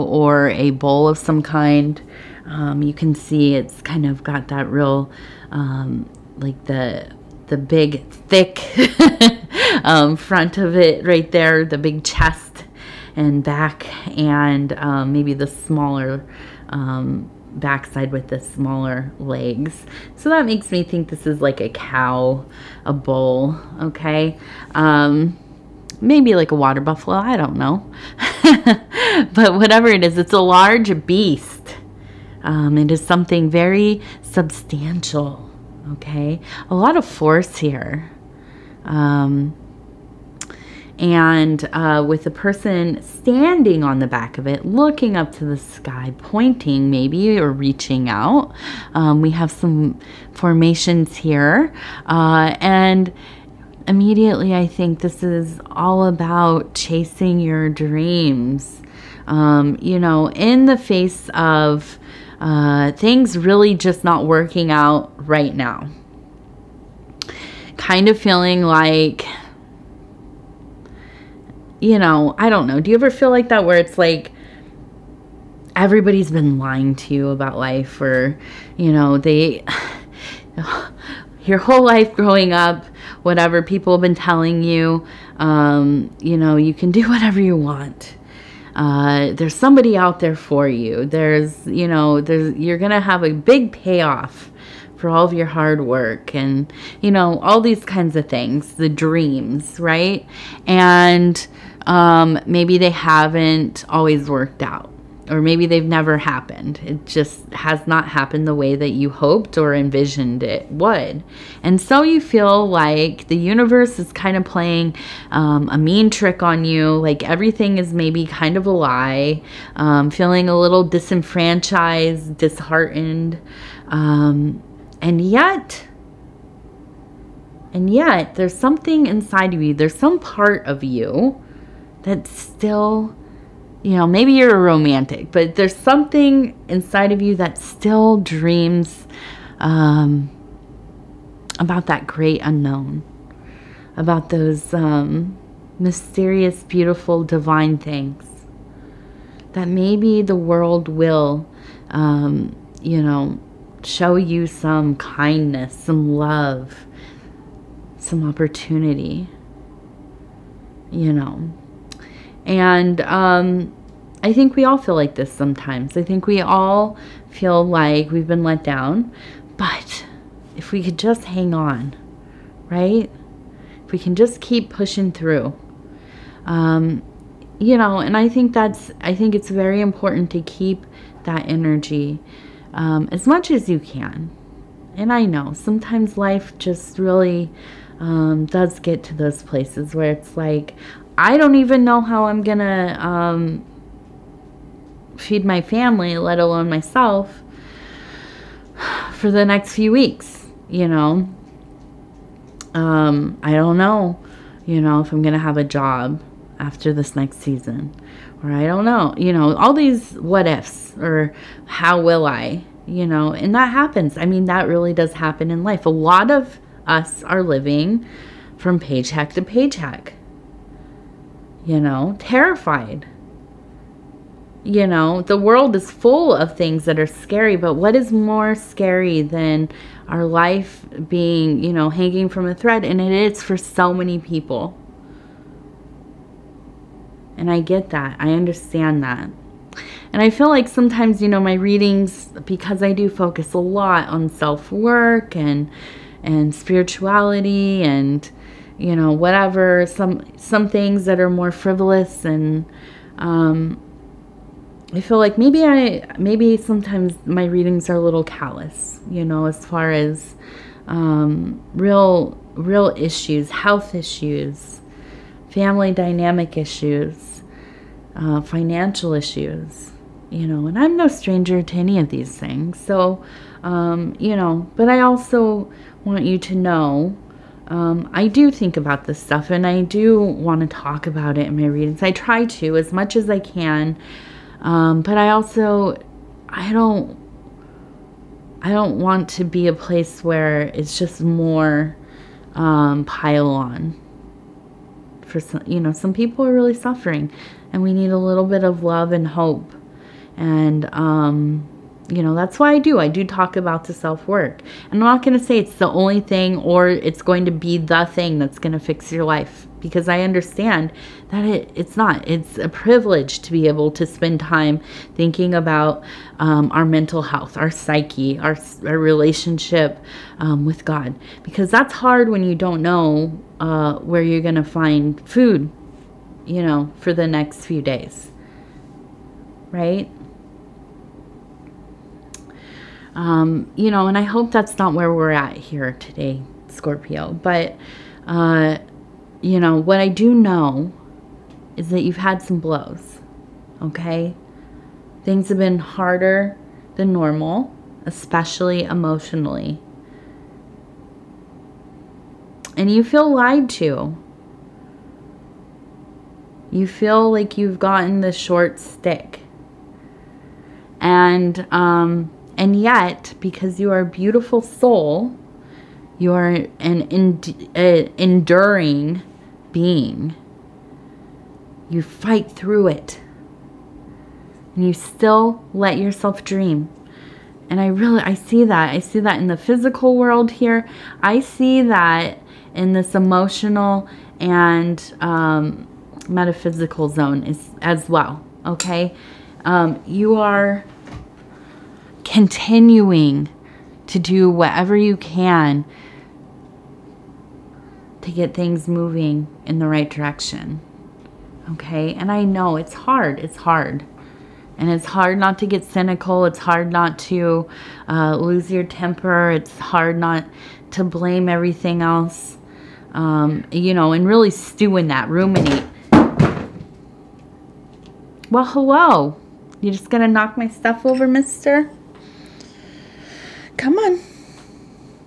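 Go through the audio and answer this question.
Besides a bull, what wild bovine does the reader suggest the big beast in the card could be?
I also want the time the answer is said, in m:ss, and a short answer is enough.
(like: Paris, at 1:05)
water buffalo, at 0:26.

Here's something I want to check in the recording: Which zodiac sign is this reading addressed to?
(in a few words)
Scorpio.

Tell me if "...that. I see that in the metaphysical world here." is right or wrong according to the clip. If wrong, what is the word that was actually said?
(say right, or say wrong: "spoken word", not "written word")
wrong: "physical", not "metaphysical".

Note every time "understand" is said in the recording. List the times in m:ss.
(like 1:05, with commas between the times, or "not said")
3:58, 5:10.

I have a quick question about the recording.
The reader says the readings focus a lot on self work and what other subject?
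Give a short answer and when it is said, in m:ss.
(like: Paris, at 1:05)
spirituality, at 4:06.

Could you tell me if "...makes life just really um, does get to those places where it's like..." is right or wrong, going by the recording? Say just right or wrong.
wrong.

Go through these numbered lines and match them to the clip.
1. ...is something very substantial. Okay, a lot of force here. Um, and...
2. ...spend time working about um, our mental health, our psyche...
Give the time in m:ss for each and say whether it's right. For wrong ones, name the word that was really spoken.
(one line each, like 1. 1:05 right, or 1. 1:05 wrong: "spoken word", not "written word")
1. 0:32 right
2. 5:14 wrong: "thinking", not "working".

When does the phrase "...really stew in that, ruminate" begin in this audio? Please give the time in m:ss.
6:54.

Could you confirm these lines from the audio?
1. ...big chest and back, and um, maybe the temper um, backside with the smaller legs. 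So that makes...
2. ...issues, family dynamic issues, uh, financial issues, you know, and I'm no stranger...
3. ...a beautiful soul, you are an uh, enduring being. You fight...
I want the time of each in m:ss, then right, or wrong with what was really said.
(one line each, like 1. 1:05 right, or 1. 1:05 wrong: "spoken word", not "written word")
1. 0:11 wrong: "smaller", not "temper"
2. 4:23 right
3. 6:03 right.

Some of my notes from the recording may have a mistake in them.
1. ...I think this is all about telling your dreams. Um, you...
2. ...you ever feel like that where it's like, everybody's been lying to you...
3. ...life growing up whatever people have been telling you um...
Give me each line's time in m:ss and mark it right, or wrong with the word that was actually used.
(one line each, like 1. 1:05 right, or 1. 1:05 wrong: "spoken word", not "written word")
1. 0:54 wrong: "chasing", not "telling"
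2. 1:12 right
3. 1:21 right.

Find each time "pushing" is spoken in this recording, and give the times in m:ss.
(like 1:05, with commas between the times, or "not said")
2:54.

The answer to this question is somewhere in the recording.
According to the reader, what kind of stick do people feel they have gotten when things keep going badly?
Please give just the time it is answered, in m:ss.
5:58.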